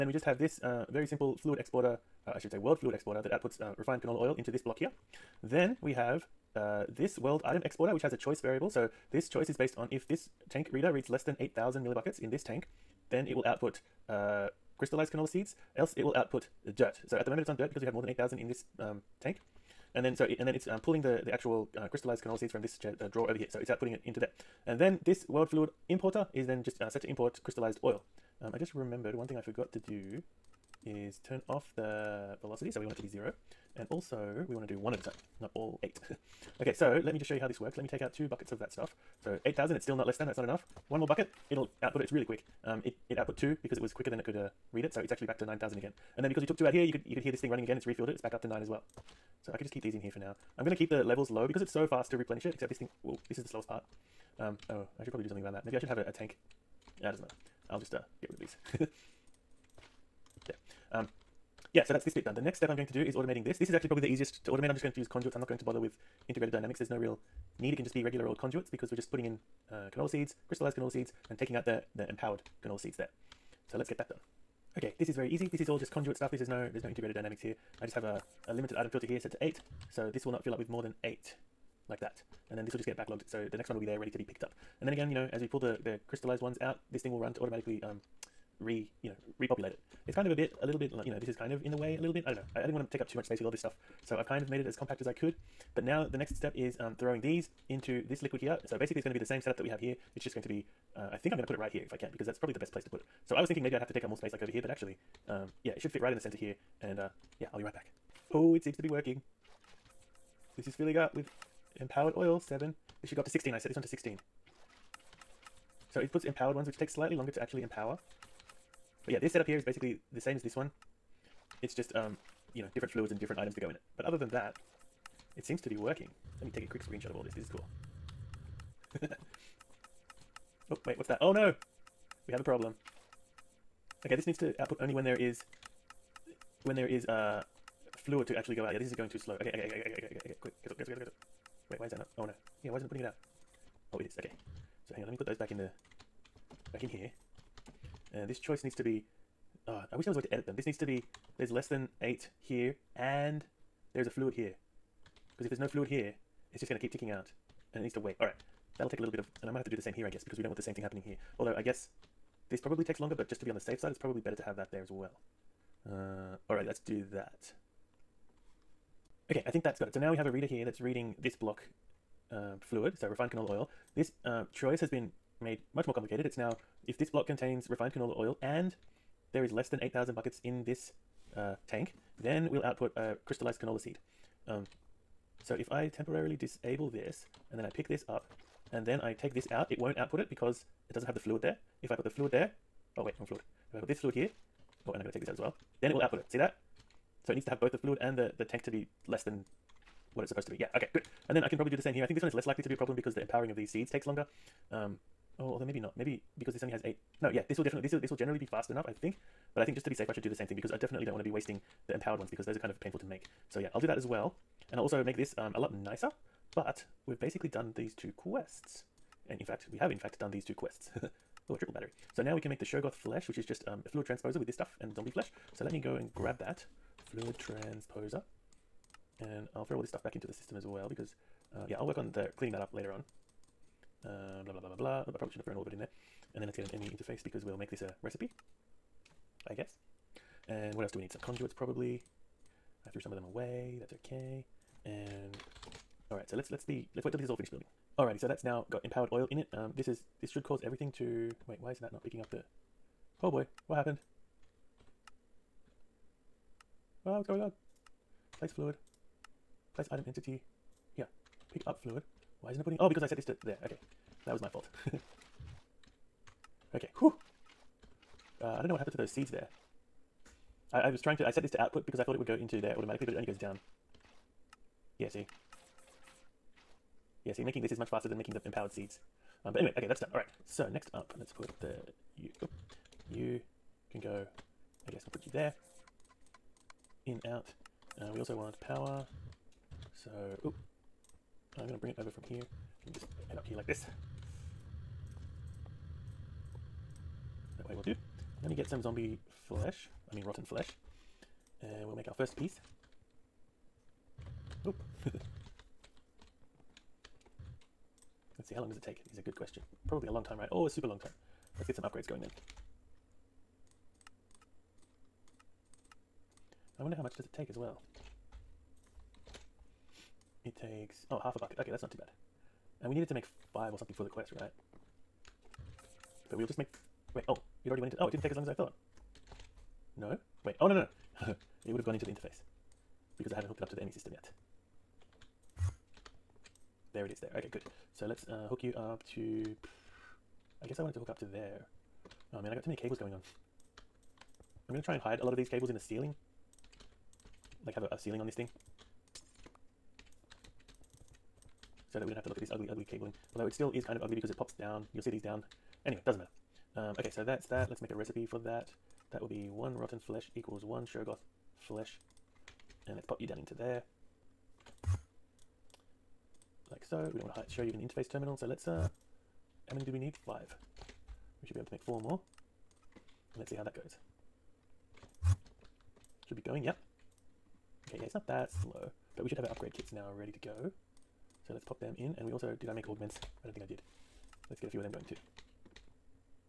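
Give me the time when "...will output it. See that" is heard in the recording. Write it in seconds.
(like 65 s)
195 s.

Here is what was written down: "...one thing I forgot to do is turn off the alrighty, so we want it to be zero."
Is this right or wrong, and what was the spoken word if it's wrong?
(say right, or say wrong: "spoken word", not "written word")
wrong: "velocity", not "alrighty".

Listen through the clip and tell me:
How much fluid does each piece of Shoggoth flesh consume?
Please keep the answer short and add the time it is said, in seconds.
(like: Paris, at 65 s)
Half a bucket, at 321 s.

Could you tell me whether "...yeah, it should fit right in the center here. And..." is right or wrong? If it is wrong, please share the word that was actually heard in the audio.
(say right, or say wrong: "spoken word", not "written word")
right.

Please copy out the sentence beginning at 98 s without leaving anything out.
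So basically it's going to be the same setup that we have here.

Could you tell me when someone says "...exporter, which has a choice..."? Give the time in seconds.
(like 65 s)
7 s.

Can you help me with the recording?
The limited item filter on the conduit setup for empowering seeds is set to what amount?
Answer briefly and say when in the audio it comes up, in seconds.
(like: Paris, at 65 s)
8, at 79 s.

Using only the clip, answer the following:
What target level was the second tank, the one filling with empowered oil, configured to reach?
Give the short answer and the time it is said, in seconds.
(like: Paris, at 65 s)
16, at 113 s.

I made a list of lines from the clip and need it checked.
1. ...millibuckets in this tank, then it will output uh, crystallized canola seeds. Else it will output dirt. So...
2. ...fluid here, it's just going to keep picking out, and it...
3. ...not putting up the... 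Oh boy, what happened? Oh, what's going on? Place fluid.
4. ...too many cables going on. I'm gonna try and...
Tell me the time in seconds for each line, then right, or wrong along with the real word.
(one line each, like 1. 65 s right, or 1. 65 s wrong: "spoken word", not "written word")
1. 11 s right
2. 155 s wrong: "ticking", not "picking"
3. 251 s wrong: "picking", not "putting"
4. 342 s right.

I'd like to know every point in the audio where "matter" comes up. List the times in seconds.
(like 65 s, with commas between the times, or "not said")
57 s, 356 s.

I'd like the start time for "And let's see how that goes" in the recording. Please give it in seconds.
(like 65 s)
373 s.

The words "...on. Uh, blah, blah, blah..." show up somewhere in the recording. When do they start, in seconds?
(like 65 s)
232 s.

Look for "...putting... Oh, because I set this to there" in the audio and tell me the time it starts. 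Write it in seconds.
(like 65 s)
262 s.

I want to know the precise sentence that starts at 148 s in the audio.
And this choice needs to be uh, I wish there was a way to edit them.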